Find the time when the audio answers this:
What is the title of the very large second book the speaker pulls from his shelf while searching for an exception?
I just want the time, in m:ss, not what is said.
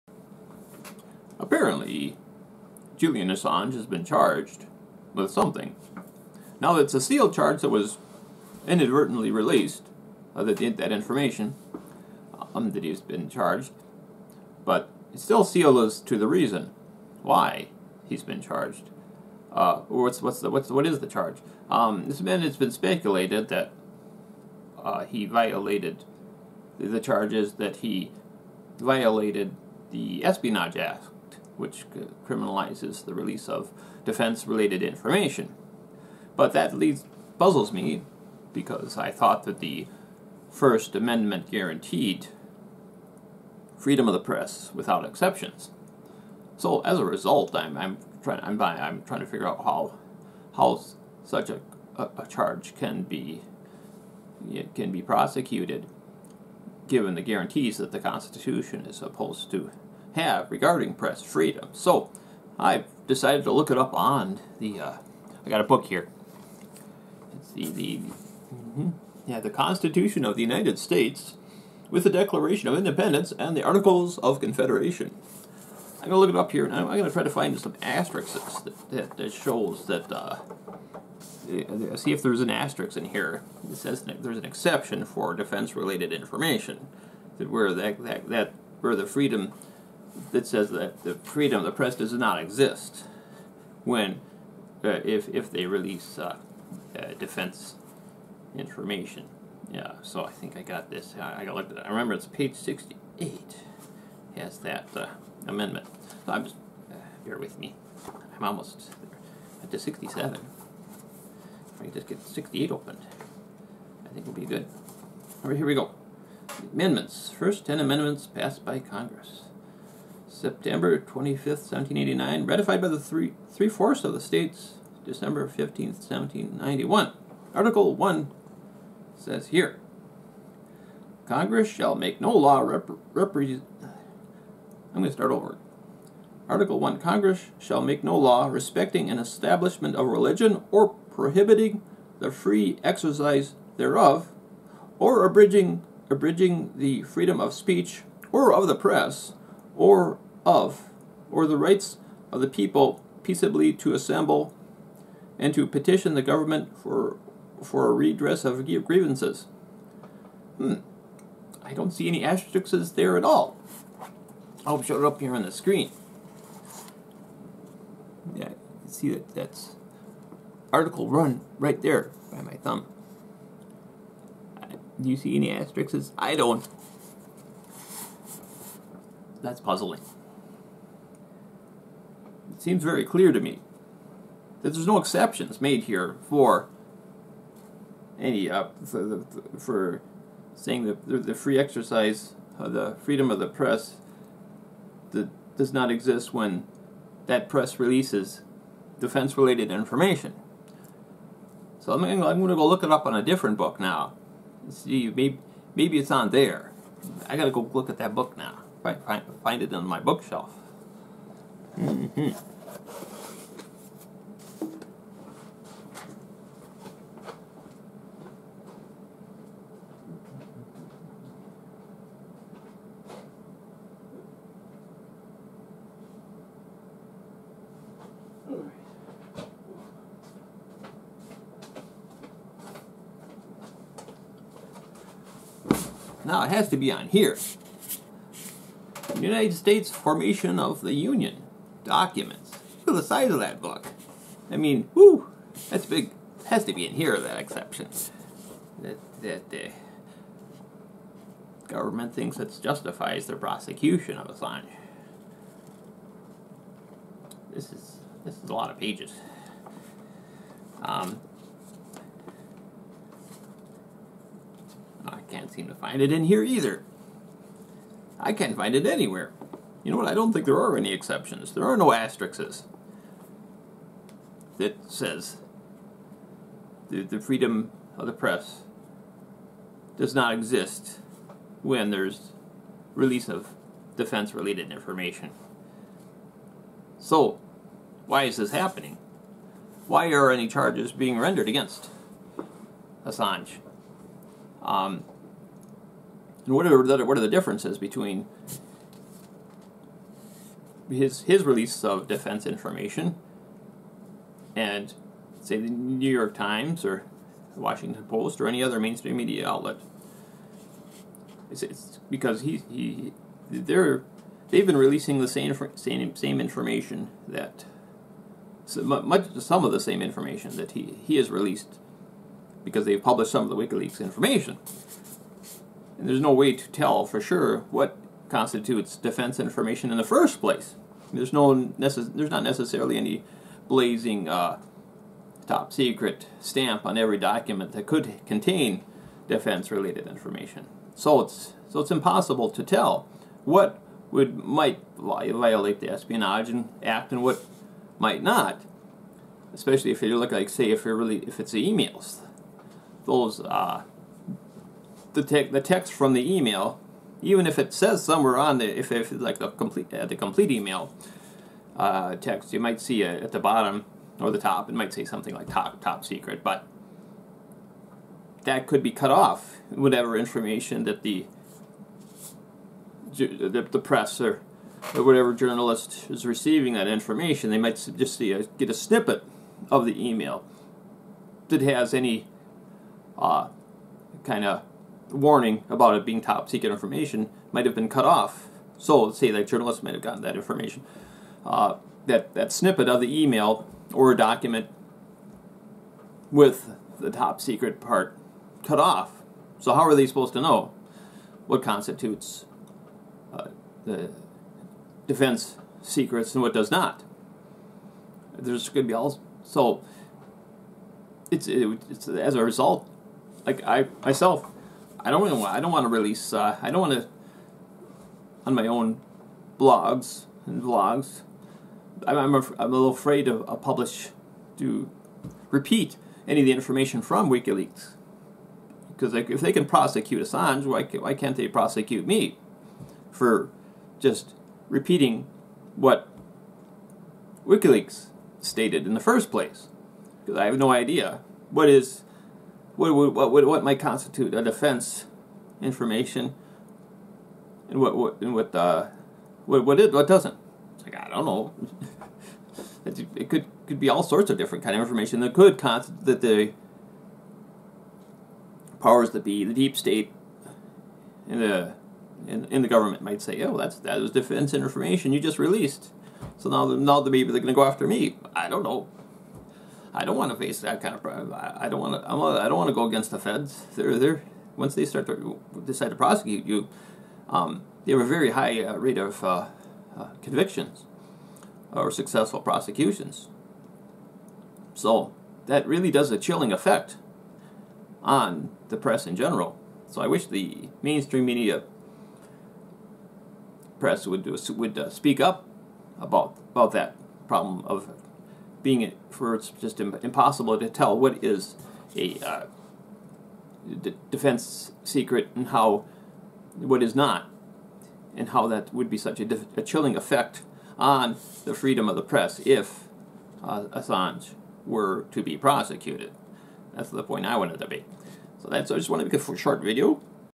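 3:59.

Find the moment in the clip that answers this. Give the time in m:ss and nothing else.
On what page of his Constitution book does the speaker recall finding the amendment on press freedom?
1:42.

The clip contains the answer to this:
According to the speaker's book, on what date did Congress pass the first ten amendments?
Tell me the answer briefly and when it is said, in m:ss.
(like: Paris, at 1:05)
September 25th, 1789, at 2:00.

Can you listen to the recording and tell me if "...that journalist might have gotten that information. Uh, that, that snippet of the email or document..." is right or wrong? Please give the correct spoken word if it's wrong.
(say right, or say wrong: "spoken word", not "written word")
right.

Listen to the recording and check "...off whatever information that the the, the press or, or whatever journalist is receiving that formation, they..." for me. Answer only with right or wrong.
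wrong.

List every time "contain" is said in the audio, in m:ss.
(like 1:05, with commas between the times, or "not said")
5:38.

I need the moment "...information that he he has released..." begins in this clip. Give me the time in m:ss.
5:20.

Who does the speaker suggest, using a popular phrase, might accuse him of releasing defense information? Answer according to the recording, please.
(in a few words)
the deep state.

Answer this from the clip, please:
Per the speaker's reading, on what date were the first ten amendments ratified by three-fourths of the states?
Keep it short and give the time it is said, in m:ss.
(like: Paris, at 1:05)
December 15th, 1791, at 2:05.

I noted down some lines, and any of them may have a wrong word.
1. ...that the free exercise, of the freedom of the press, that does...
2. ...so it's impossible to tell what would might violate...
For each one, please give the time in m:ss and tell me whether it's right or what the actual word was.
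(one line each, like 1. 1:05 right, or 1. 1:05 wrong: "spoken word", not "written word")
1. 3:10 right
2. 5:41 right.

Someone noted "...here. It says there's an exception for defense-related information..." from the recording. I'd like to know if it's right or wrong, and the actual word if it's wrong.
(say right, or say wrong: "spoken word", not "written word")
right.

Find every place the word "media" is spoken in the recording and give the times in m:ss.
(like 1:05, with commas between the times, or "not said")
5:09, 8:11.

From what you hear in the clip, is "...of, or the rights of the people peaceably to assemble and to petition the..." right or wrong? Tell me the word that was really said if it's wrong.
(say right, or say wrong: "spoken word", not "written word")
right.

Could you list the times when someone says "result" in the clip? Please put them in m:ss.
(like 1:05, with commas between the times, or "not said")
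0:47, 6:52.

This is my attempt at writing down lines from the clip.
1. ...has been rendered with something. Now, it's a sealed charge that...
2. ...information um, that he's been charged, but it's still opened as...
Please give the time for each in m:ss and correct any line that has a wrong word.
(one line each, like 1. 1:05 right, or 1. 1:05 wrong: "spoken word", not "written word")
1. 0:03 wrong: "charged", not "rendered"
2. 0:10 wrong: "sealed", not "opened".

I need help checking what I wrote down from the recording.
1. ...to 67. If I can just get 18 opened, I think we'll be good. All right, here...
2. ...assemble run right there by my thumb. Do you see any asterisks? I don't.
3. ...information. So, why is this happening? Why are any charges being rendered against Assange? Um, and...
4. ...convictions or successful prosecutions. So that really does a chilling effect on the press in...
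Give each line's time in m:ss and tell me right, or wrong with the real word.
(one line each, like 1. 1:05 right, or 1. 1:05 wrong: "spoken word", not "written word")
1. 1:49 wrong: "68", not "18"
2. 2:50 wrong: "article", not "assemble"
3. 4:44 right
4. 8:00 right.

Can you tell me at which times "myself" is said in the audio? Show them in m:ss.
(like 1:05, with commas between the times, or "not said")
6:54.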